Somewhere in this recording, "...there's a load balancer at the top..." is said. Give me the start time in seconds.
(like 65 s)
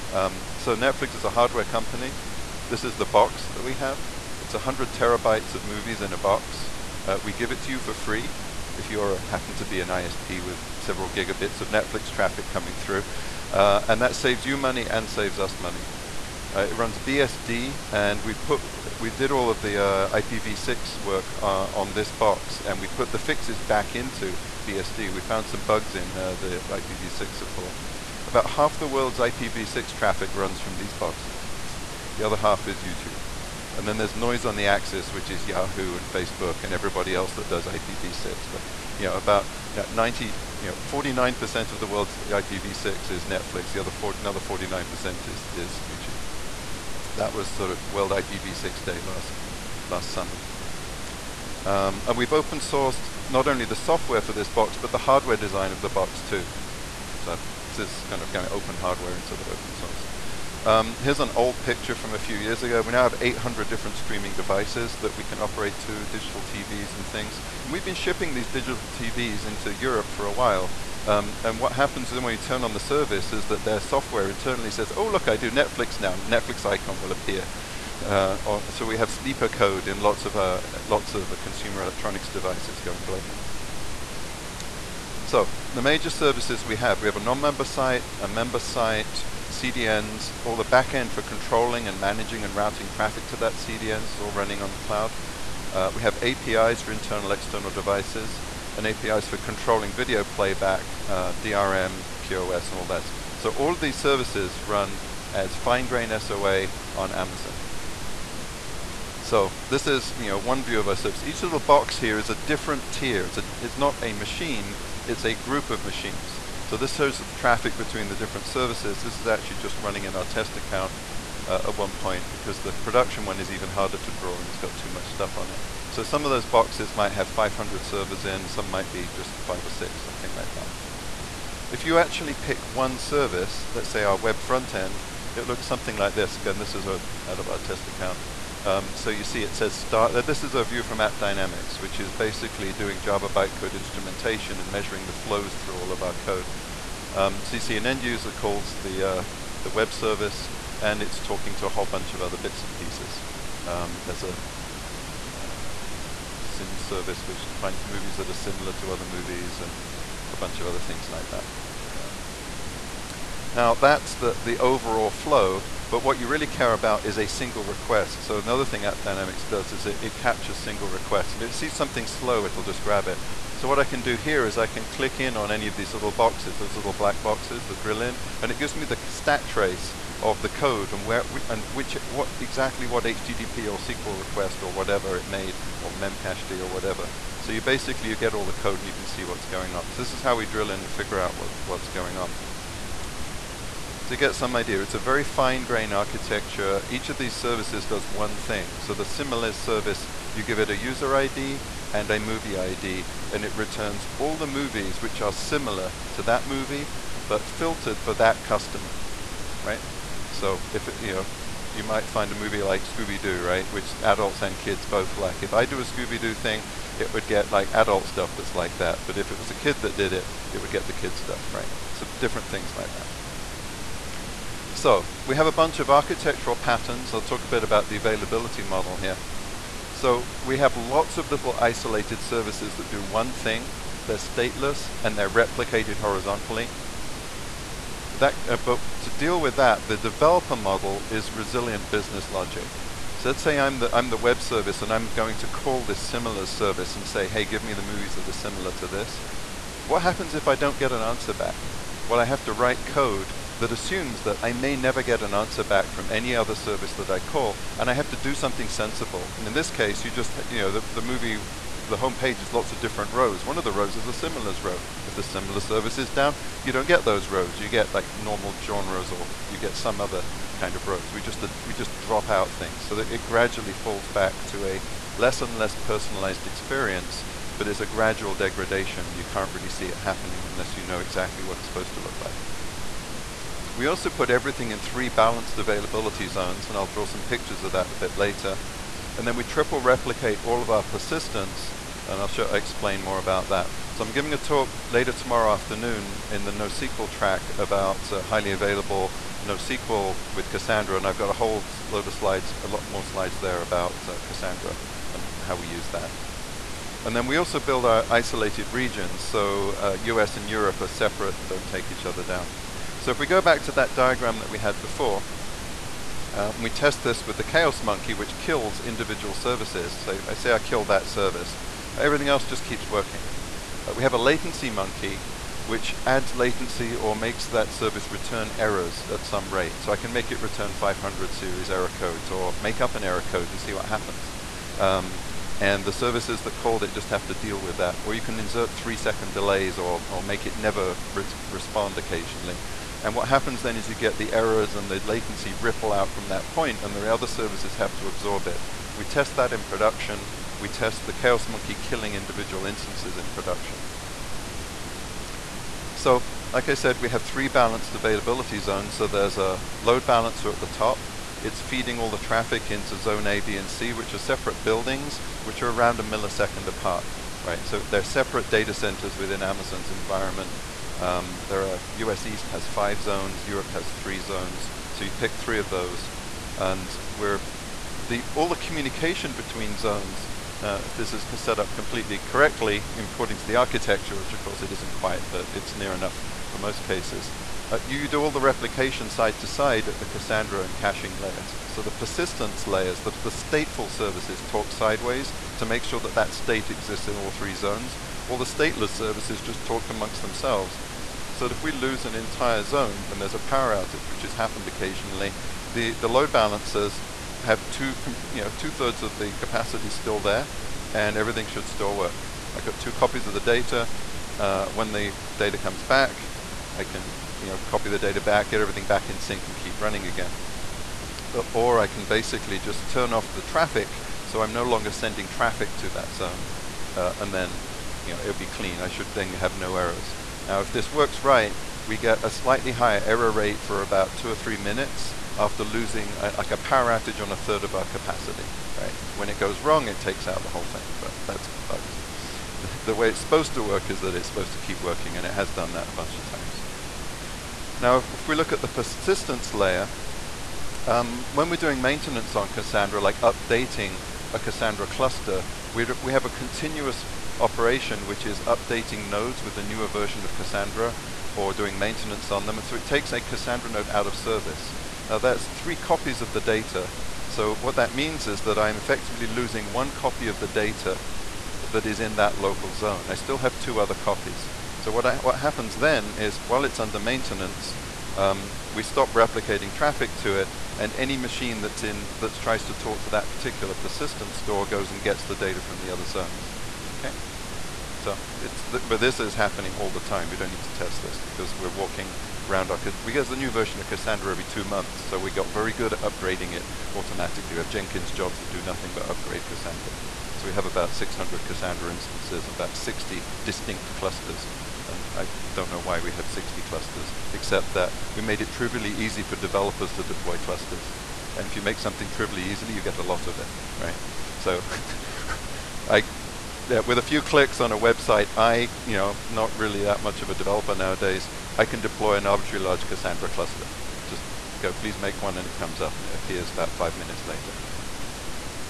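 359 s.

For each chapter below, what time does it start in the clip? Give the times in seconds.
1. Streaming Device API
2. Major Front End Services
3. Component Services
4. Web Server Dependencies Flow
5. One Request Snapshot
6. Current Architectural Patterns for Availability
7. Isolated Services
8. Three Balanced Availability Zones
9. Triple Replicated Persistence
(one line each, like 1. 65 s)
1. 62 s
2. 84 s
3. 109 s
4. 134 s
5. 179 s
6. 230 s
7. 316 s
8. 356 s
9. 449 s.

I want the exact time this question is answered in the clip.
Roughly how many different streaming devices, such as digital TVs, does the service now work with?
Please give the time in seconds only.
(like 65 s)
63 s.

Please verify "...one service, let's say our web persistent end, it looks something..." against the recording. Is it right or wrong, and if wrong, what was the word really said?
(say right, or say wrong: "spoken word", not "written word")
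wrong: "front", not "persistent".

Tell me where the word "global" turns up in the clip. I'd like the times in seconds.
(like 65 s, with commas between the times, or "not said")
83 s.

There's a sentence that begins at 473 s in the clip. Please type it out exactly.
I still have two other copies.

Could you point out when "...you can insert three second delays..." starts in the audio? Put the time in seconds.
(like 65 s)
338 s.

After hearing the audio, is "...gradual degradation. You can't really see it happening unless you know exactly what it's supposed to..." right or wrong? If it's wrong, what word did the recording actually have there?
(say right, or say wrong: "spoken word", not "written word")
right.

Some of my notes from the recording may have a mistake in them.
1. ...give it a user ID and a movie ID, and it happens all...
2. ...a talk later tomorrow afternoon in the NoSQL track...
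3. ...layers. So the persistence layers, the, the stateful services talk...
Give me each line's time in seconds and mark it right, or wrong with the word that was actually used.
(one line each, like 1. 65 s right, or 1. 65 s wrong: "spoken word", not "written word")
1. 200 s wrong: "returns", not "happens"
2. 294 s right
3. 391 s right.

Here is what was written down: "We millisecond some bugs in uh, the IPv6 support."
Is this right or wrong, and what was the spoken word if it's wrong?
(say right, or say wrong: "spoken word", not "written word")
wrong: "found", not "millisecond".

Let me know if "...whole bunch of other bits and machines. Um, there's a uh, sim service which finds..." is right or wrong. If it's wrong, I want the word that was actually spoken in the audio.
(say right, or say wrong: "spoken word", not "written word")
wrong: "pieces", not "machines".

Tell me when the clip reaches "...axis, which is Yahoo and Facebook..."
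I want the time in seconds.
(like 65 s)
34 s.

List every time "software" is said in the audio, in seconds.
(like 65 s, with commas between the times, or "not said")
53 s, 73 s.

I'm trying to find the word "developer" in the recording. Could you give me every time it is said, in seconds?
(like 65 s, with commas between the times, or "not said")
239 s, 509 s, 520 s.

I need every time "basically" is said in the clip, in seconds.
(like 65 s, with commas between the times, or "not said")
142 s, 187 s, 422 s.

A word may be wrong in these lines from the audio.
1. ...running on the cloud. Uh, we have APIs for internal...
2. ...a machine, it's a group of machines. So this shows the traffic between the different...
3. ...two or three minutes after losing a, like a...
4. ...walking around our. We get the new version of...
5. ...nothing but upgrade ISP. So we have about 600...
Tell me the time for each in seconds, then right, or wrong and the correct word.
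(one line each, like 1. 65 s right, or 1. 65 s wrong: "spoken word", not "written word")
1. 94 s right
2. 114 s right
3. 434 s right
4. 491 s right
5. 498 s wrong: "Cassandra", not "ISP".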